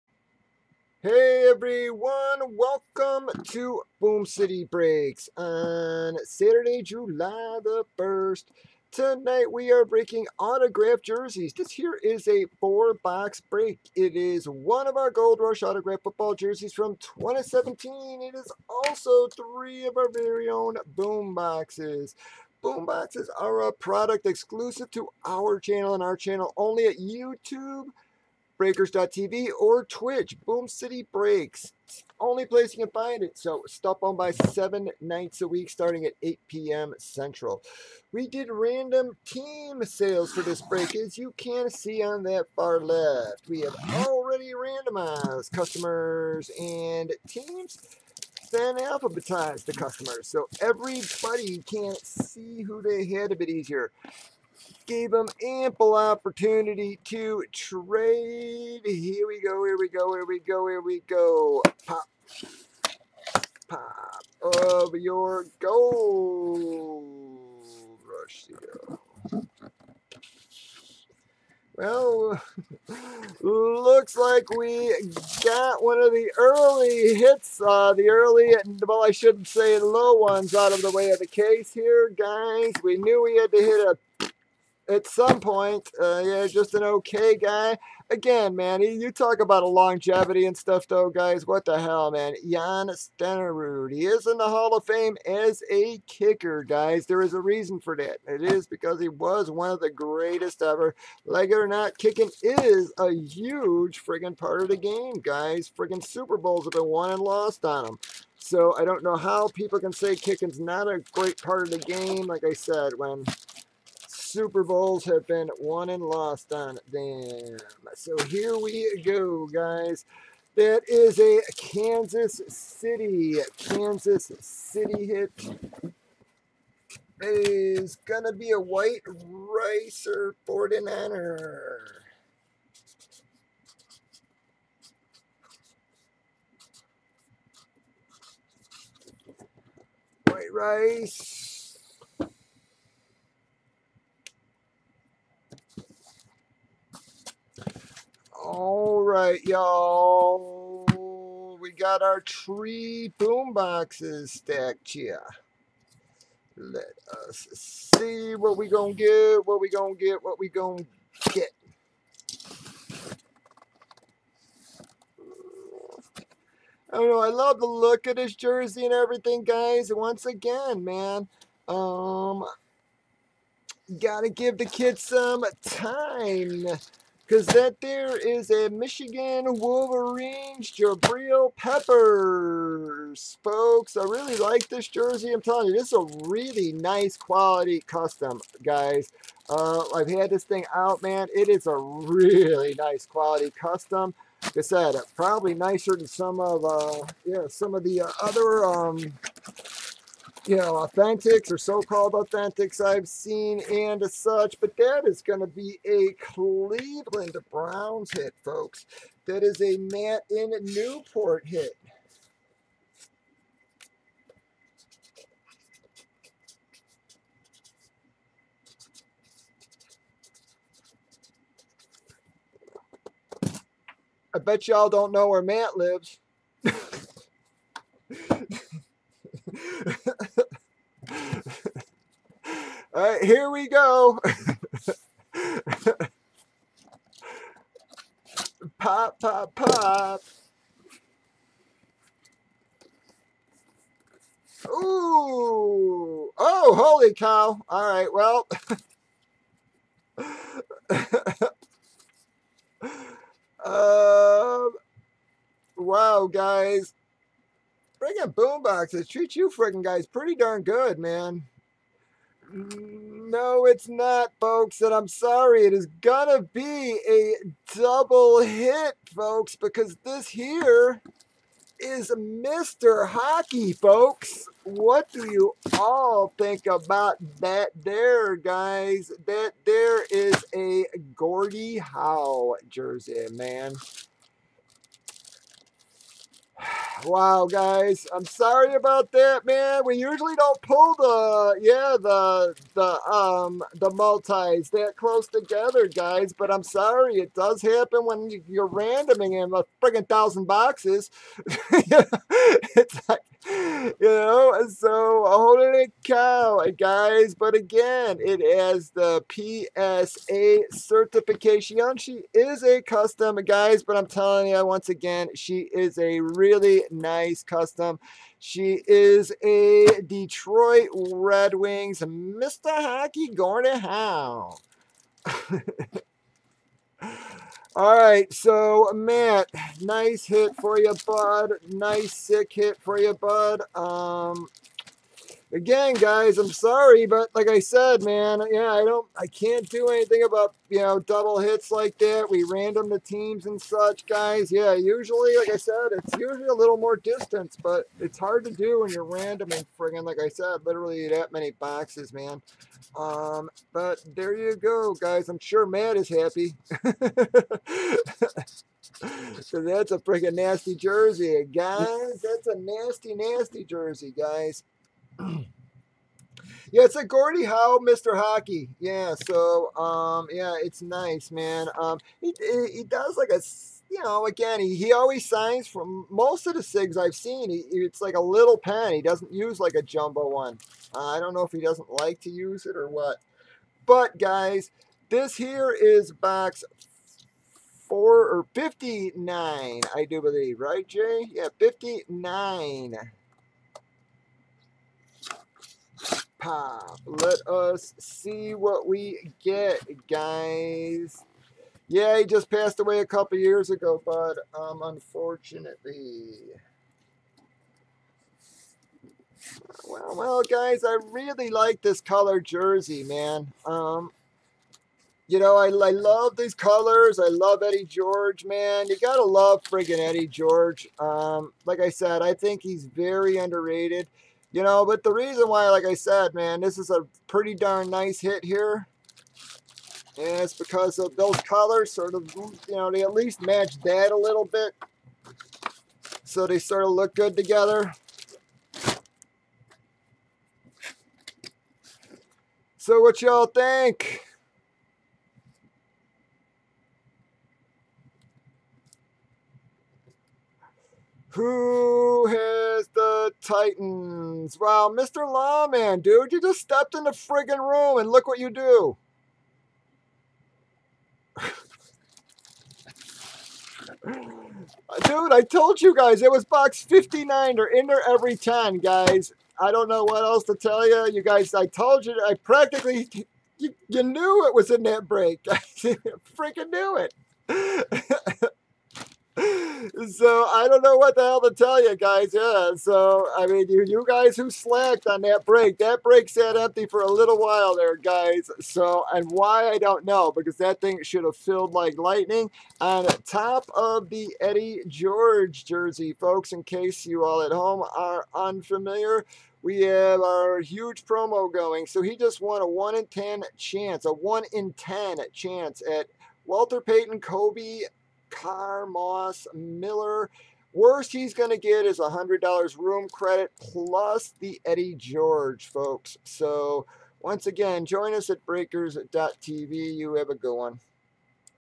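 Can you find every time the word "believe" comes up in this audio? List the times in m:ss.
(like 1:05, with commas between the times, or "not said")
6:30.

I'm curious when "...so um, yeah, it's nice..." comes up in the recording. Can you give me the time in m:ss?
6:09.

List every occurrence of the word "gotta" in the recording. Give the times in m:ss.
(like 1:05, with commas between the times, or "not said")
2:53, 6:58.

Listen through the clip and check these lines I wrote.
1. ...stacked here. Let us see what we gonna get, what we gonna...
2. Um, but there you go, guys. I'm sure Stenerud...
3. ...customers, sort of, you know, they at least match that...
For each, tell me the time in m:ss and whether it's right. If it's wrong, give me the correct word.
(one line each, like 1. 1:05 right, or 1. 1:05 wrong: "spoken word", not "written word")
1. 2:34 right
2. 5:52 wrong: "Matt", not "Stenerud"
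3. 7:11 wrong: "colors", not "customers".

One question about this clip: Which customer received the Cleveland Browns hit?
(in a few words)
Matt in Newport.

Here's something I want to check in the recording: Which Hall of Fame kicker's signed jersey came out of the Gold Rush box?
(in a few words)
Jan Stenerud.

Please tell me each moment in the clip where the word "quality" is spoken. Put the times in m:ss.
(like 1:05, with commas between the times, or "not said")
3:07, 3:13.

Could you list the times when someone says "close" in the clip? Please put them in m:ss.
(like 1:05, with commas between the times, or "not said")
4:54.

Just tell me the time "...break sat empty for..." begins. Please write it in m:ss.
8:06.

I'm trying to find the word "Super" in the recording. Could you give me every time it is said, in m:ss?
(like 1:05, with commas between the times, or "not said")
1:46, 1:54.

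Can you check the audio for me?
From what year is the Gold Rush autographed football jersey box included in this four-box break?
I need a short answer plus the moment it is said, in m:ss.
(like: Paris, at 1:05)
2017, at 0:16.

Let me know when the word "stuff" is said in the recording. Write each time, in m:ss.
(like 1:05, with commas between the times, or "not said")
1:30.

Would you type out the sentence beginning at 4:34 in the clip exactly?
What do you all think about that there, guys?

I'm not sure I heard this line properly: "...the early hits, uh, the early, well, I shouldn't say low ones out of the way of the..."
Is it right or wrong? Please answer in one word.
right.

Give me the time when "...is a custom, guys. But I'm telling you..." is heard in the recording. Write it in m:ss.
5:12.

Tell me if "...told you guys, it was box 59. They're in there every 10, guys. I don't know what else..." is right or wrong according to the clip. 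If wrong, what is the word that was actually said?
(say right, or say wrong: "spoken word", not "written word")
right.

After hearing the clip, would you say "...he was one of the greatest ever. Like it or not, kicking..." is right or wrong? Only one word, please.
right.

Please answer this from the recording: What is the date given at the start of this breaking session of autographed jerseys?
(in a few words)
Saturday, July 1st.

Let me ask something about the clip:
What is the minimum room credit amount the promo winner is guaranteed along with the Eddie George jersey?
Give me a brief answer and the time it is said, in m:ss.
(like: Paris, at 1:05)
$100, at 8:31.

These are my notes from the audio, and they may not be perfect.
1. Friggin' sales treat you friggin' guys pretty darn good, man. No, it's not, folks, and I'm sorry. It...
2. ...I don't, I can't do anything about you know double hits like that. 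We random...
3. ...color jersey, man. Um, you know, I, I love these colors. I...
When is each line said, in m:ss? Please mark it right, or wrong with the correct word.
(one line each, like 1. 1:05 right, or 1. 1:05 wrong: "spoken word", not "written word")
1. 4:17 wrong: "boomboxes", not "sales"
2. 5:38 right
3. 6:52 right.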